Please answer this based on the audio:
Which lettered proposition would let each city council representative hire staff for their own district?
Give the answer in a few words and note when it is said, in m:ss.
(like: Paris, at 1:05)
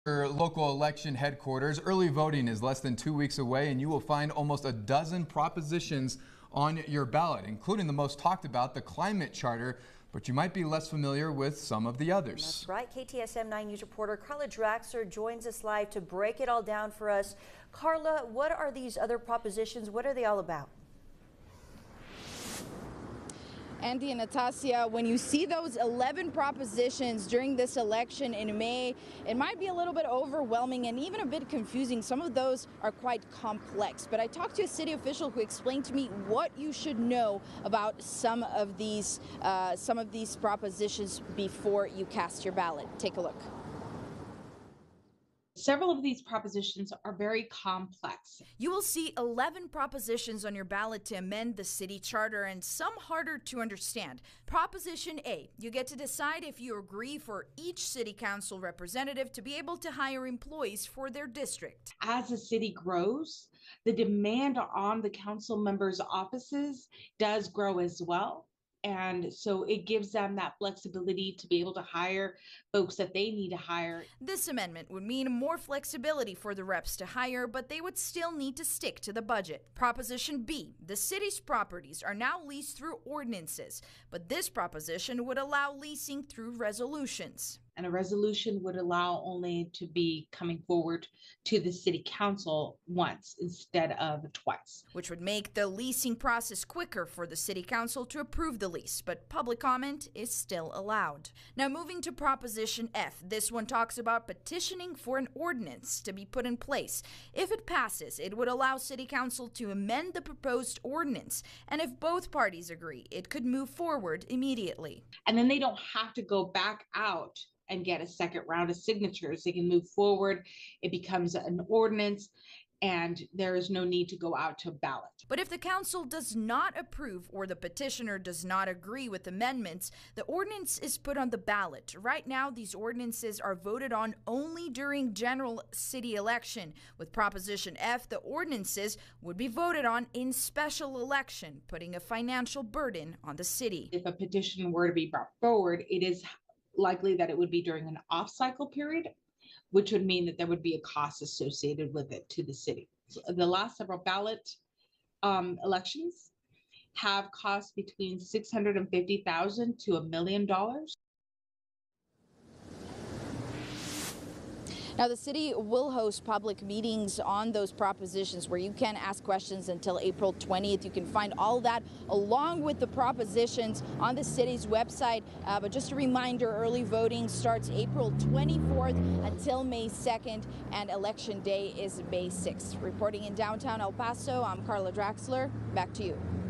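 Proposition A, at 0:54.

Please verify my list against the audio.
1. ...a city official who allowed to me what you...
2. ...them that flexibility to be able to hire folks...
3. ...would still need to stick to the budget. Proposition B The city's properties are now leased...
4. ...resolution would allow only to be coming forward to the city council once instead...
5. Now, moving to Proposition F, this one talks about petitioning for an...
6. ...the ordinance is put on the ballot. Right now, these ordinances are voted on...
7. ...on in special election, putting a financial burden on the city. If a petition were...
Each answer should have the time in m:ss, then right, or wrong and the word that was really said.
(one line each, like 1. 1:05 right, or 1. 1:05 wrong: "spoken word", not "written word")
1. 0:34 wrong: "explained", not "allowed"
2. 1:10 right
3. 1:17 right
4. 1:27 right
5. 1:41 right
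6. 2:10 right
7. 2:19 right.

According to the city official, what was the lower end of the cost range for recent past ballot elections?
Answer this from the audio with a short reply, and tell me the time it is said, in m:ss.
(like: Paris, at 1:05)
650,000, at 2:38.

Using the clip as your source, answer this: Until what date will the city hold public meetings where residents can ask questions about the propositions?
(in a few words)
April 20th.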